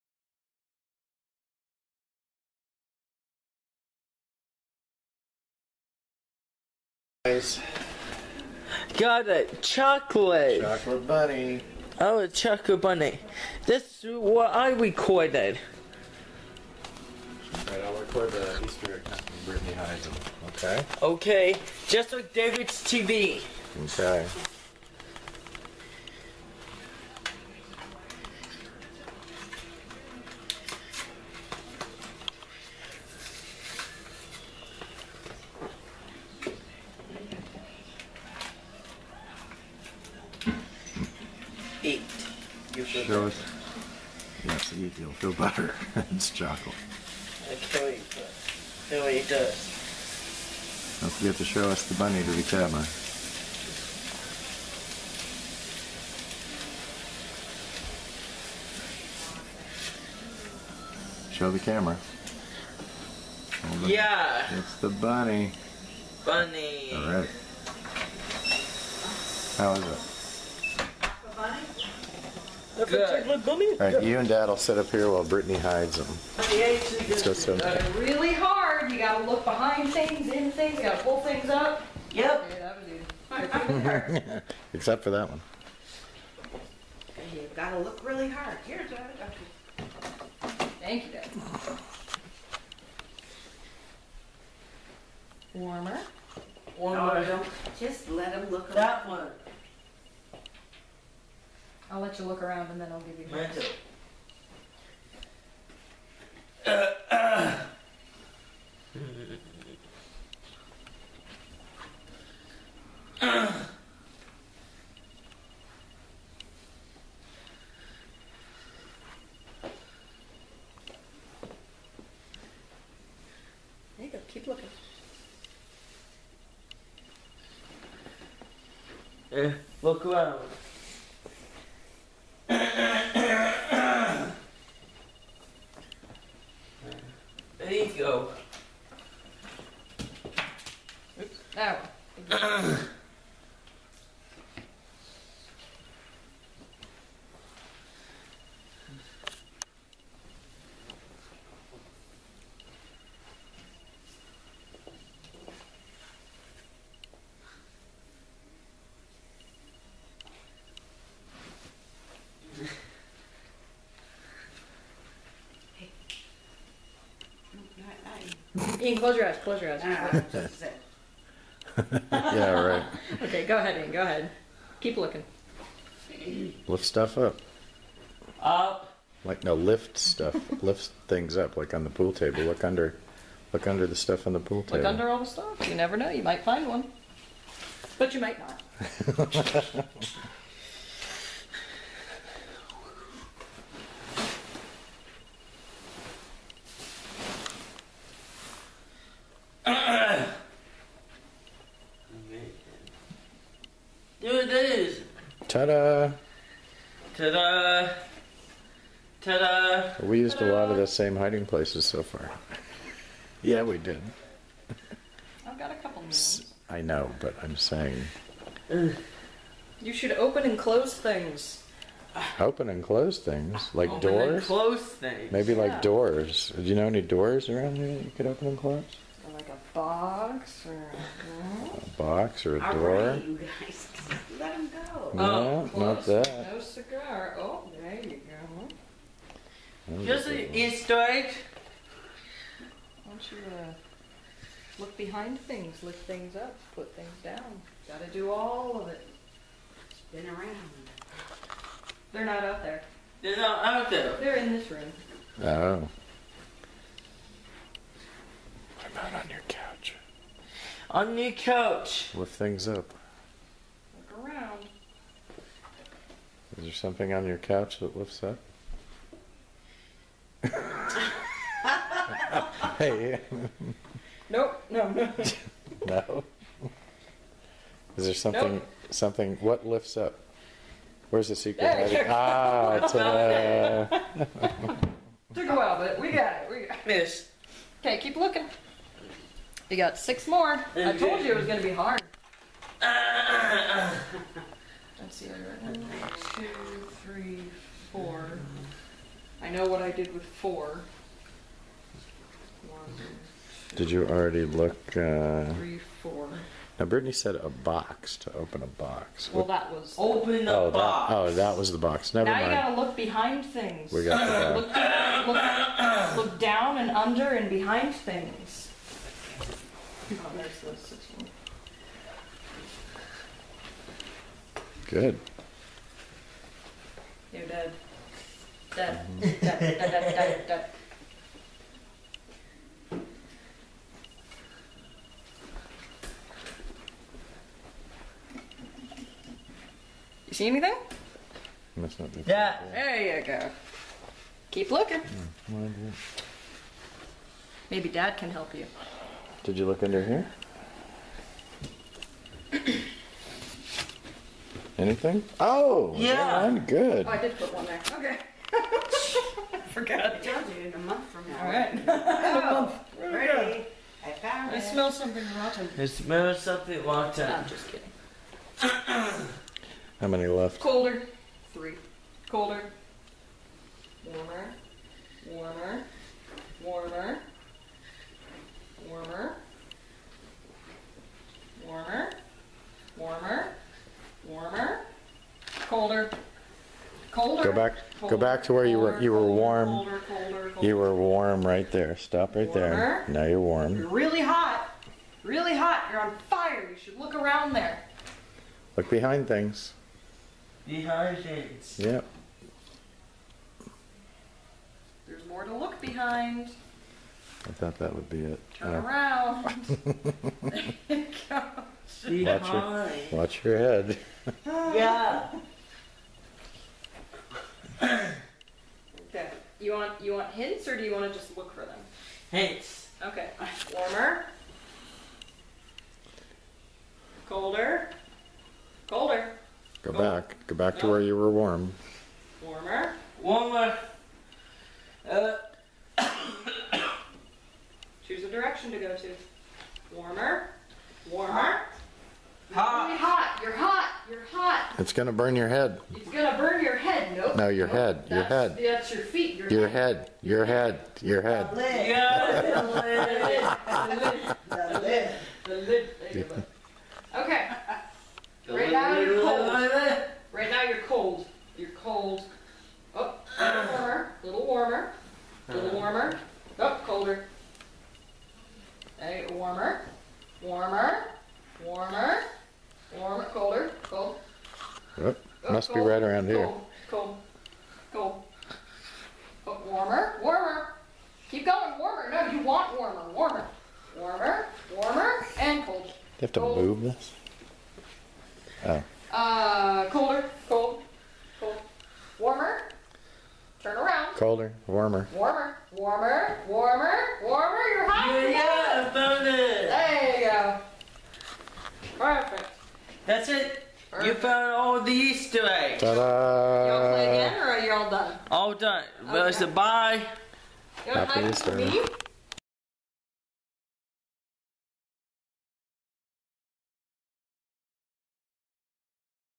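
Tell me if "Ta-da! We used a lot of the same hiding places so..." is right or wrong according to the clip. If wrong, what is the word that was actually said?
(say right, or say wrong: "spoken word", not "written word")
right.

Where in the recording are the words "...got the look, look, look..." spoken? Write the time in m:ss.
5:14.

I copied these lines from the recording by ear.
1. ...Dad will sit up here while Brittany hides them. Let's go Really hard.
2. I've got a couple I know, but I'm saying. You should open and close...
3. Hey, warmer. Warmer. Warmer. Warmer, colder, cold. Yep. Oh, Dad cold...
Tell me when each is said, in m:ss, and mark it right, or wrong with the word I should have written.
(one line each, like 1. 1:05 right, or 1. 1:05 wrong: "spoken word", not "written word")
1. 1:14 right
2. 3:35 right
3. 7:48 wrong: "Must", not "Dad".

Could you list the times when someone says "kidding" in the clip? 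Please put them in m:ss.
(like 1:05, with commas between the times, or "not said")
6:07.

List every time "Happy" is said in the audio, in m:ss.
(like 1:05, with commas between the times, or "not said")
8:30.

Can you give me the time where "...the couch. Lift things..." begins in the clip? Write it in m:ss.
4:21.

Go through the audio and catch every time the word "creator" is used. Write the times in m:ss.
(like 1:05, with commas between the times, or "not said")
not said.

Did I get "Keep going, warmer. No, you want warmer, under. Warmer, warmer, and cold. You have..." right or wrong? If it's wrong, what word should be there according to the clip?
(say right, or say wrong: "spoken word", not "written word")
wrong: "warmer", not "under".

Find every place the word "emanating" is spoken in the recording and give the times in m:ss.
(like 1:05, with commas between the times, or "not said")
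not said.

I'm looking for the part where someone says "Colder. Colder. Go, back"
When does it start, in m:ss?
7:07.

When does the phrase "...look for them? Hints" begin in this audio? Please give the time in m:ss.
7:01.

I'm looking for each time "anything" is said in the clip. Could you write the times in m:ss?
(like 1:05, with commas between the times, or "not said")
5:40, 5:54.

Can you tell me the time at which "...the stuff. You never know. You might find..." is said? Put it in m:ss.
3:05.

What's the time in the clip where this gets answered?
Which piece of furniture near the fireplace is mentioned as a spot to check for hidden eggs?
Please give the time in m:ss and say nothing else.
1:43.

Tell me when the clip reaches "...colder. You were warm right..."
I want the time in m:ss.
6:30.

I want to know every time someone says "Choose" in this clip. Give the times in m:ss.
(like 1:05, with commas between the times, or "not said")
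7:18.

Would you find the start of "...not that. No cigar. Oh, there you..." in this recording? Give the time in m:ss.
3:55.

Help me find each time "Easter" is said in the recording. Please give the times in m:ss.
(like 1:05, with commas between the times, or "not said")
0:18, 4:00, 8:24, 8:31.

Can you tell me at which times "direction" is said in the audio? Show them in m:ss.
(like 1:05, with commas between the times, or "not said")
7:18.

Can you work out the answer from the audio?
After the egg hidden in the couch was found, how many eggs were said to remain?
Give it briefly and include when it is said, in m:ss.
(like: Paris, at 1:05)
6, at 4:49.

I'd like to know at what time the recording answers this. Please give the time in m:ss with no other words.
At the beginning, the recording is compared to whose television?
0:22.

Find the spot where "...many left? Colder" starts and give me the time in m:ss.
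6:10.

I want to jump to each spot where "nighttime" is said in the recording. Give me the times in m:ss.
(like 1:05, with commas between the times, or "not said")
not said.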